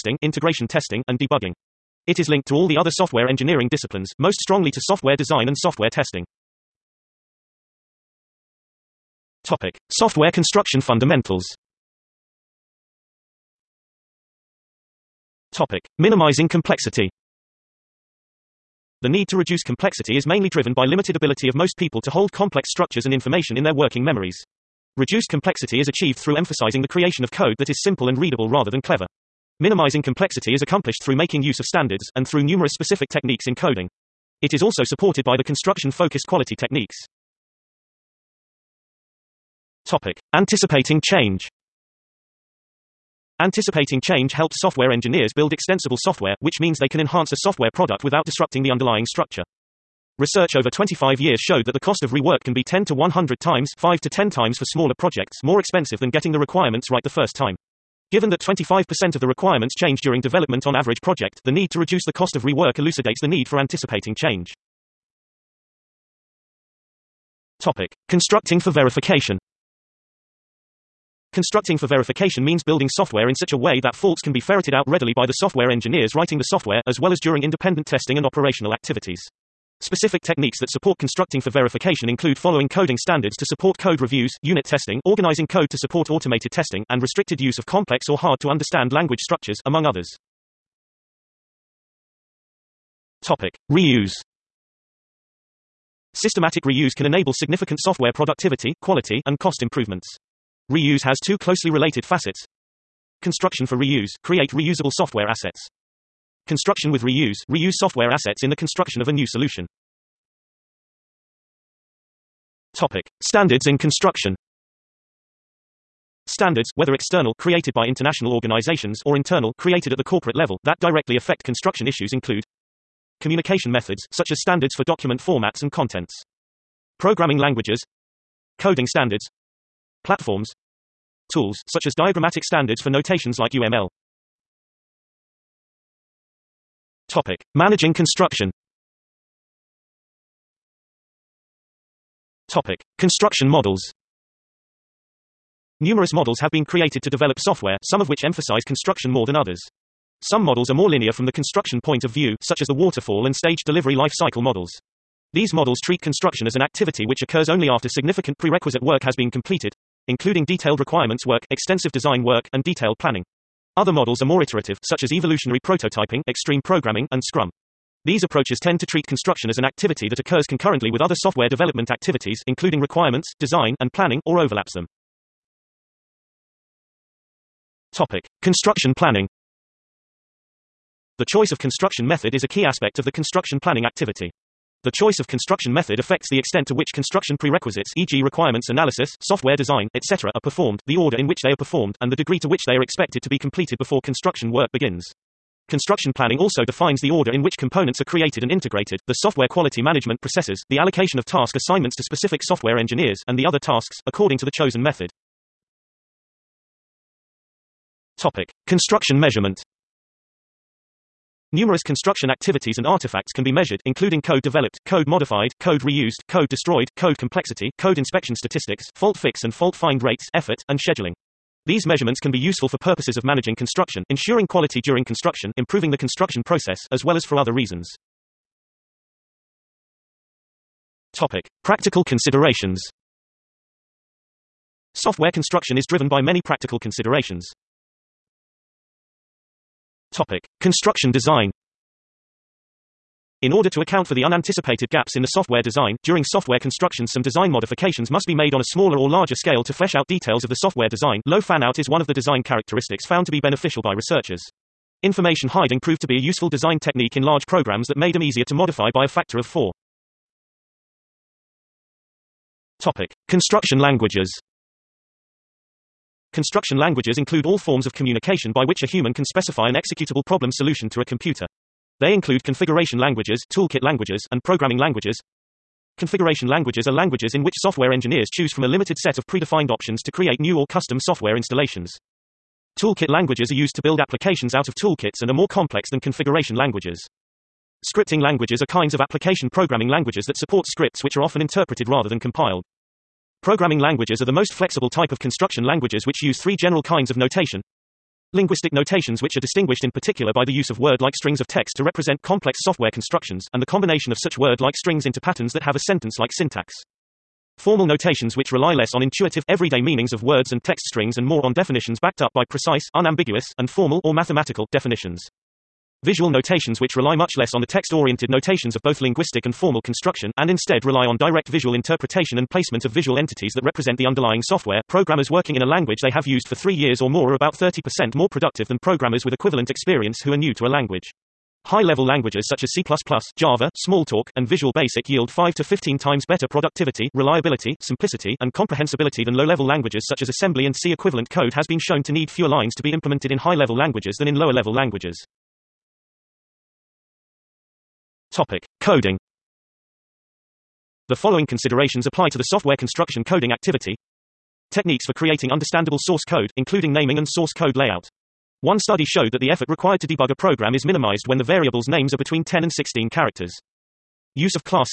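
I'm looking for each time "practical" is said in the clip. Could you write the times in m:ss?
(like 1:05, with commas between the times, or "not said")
3:51, 3:56.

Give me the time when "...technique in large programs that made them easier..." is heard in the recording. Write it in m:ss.
4:16.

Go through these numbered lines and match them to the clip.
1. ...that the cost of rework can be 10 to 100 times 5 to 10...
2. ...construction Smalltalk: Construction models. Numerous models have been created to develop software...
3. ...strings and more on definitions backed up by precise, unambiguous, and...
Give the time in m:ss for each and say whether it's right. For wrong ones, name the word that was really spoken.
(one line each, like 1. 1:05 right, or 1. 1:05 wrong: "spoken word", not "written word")
1. 0:51 right
2. 2:17 wrong: "Topic", not "Smalltalk"
3. 5:10 right.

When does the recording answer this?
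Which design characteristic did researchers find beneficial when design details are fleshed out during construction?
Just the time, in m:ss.
4:11.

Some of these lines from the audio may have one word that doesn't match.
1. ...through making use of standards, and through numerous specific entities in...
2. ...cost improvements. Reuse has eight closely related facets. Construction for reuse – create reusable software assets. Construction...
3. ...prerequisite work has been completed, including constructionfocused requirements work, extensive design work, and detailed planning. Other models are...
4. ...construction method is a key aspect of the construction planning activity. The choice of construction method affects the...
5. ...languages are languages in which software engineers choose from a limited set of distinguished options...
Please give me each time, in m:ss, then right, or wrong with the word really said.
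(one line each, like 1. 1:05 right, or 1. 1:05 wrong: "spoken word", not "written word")
1. 0:31 wrong: "techniques", not "entities"
2. 1:39 wrong: "two", not "eight"
3. 2:38 wrong: "detailed", not "constructionfocused"
4. 3:01 right
5. 4:36 wrong: "predefined", not "distinguished".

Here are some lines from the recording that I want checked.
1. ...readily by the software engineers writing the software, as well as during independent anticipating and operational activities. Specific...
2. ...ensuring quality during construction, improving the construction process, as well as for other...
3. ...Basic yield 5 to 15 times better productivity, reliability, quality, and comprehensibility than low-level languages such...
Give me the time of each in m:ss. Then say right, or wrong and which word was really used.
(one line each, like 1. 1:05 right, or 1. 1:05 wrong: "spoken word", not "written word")
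1. 1:14 wrong: "testing", not "anticipating"
2. 3:44 right
3. 5:34 wrong: "simplicity", not "quality".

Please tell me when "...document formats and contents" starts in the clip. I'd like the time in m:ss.
2:04.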